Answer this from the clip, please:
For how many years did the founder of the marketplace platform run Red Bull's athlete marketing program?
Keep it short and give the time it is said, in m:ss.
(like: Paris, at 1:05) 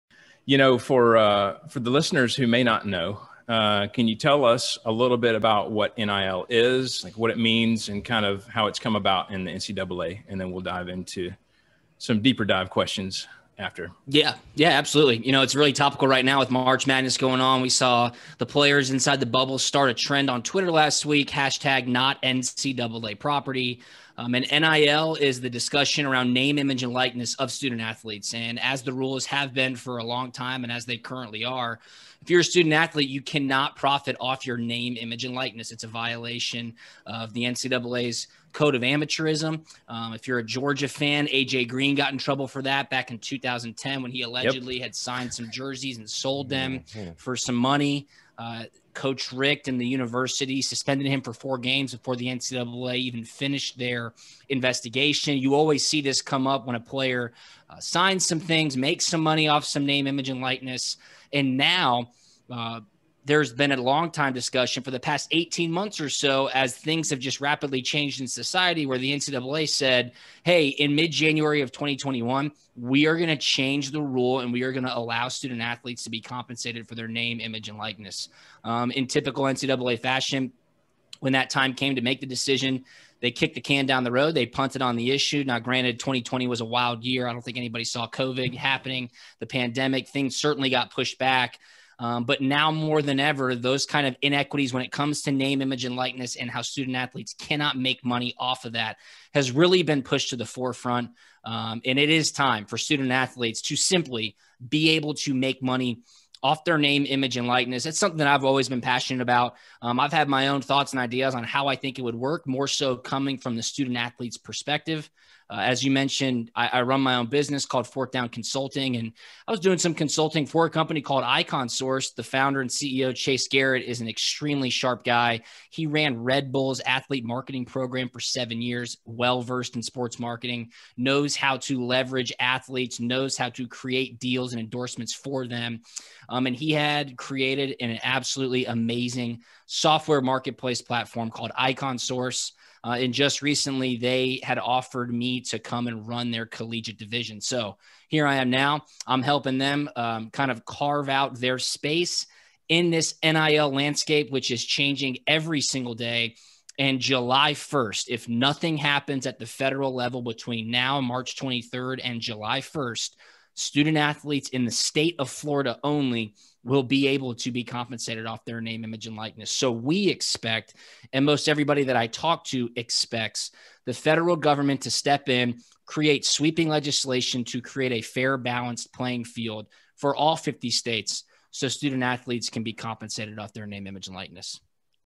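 7, at 2:08.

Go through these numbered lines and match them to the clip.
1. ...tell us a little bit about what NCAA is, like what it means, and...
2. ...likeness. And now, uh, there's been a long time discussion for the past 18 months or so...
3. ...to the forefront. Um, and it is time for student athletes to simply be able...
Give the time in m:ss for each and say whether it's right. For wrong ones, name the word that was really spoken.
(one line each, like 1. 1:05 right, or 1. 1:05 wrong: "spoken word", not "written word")
1. 0:04 wrong: "NIL", not "NCAA"
2. 1:00 right
3. 1:40 right.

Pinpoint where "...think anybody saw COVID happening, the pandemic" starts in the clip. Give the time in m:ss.
1:27.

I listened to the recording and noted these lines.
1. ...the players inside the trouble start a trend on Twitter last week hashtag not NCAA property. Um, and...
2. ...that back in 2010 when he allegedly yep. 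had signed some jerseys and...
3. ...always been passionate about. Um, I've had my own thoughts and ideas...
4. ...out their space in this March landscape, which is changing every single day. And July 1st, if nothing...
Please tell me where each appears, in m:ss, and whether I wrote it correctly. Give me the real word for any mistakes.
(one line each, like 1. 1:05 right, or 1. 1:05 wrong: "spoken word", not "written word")
1. 0:18 wrong: "bubble", not "trouble"
2. 0:42 right
3. 1:48 right
4. 2:31 wrong: "NIL", not "March".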